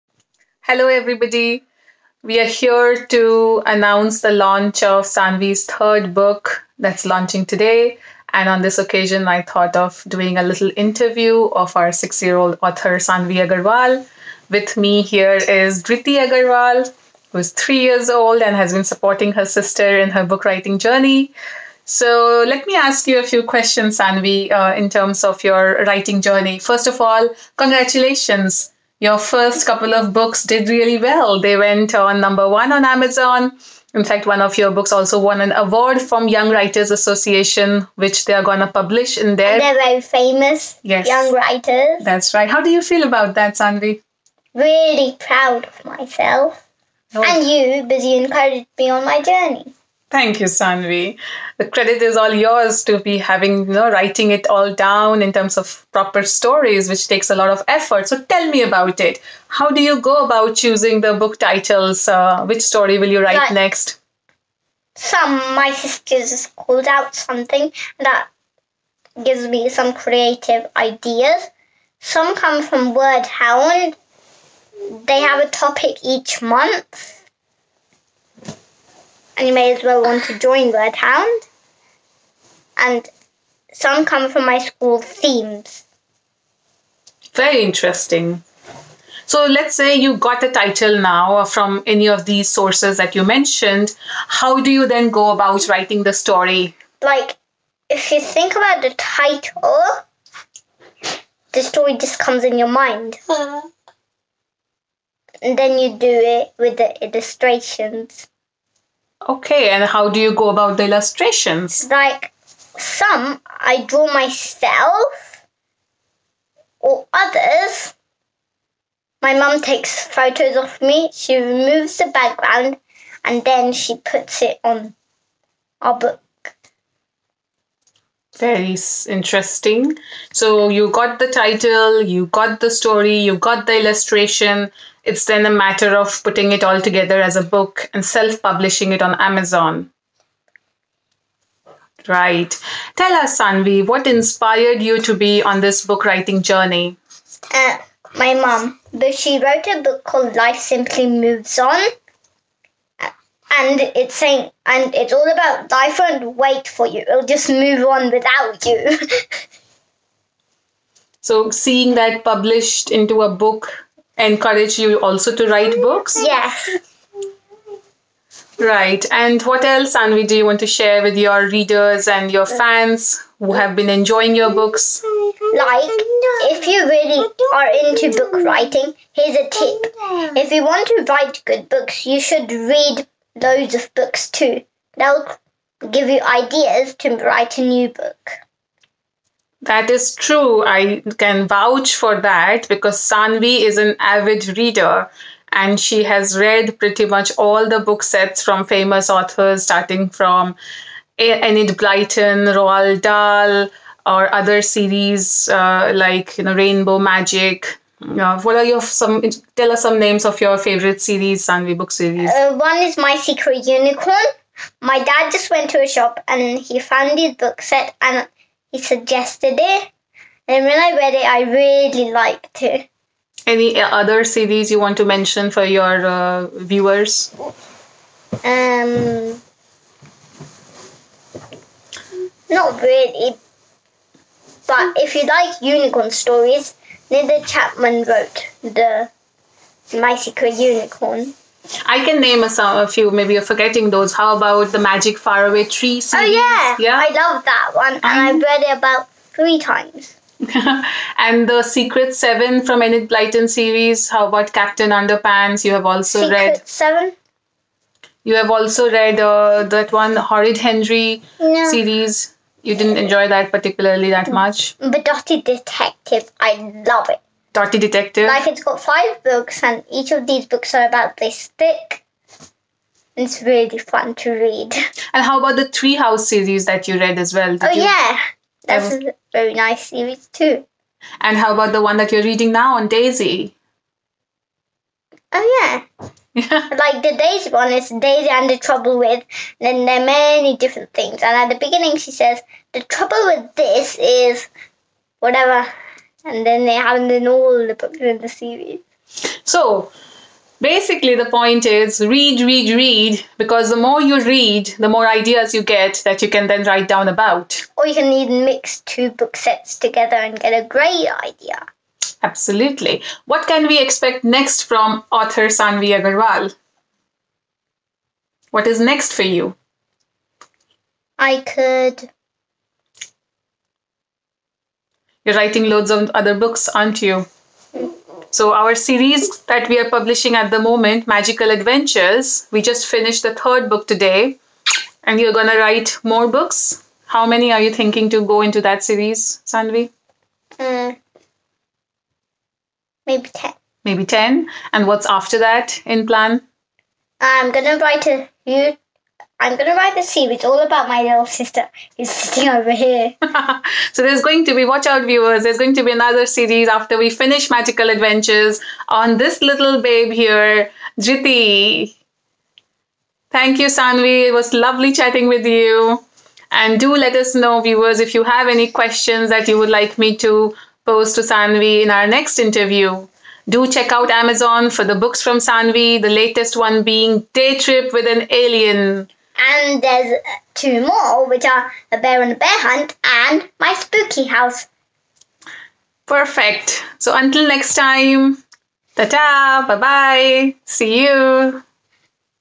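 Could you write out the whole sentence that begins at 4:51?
And at the beginning, she says, The trouble with this is whatever.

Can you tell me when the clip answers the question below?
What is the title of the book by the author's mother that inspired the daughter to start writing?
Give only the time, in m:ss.
2:30.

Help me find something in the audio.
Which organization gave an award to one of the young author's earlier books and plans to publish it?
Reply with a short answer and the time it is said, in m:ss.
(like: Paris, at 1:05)
Young Writers Association, at 0:36.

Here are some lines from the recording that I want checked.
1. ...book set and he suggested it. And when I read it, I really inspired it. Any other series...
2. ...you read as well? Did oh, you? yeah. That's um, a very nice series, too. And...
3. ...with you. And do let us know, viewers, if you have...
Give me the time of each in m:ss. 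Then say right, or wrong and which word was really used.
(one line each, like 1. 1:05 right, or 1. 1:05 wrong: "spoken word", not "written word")
1. 3:37 wrong: "liked", not "inspired"
2. 4:36 right
3. 6:05 right.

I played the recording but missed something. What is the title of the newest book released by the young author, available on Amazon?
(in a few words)
Day Trip with an Alien.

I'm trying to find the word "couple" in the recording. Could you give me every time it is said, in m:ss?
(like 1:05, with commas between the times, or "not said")
0:29.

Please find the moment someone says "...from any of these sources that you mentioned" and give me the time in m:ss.
1:31.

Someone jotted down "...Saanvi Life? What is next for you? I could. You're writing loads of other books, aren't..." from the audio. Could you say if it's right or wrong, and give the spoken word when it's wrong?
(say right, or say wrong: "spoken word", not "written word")
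wrong: "Agarwal", not "Life".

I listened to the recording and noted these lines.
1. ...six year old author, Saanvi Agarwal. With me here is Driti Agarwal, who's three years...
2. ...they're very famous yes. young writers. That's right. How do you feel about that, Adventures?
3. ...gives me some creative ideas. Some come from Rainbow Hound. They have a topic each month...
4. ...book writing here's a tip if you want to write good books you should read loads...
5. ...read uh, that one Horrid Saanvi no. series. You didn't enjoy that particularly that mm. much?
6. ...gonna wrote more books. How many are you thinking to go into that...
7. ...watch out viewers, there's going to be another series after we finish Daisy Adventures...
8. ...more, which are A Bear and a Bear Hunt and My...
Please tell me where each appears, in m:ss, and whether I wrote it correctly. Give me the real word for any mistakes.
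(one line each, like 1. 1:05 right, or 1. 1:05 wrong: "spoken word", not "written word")
1. 0:11 right
2. 0:39 wrong: "Saanvi", not "Adventures"
3. 1:09 wrong: "Word", not "Rainbow"
4. 2:58 right
5. 4:18 wrong: "Henry", not "Saanvi"
6. 5:35 wrong: "write", not "wrote"
7. 5:54 wrong: "Magical", not "Daisy"
8. 6:20 right.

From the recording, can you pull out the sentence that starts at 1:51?
Like some I draw myself or others.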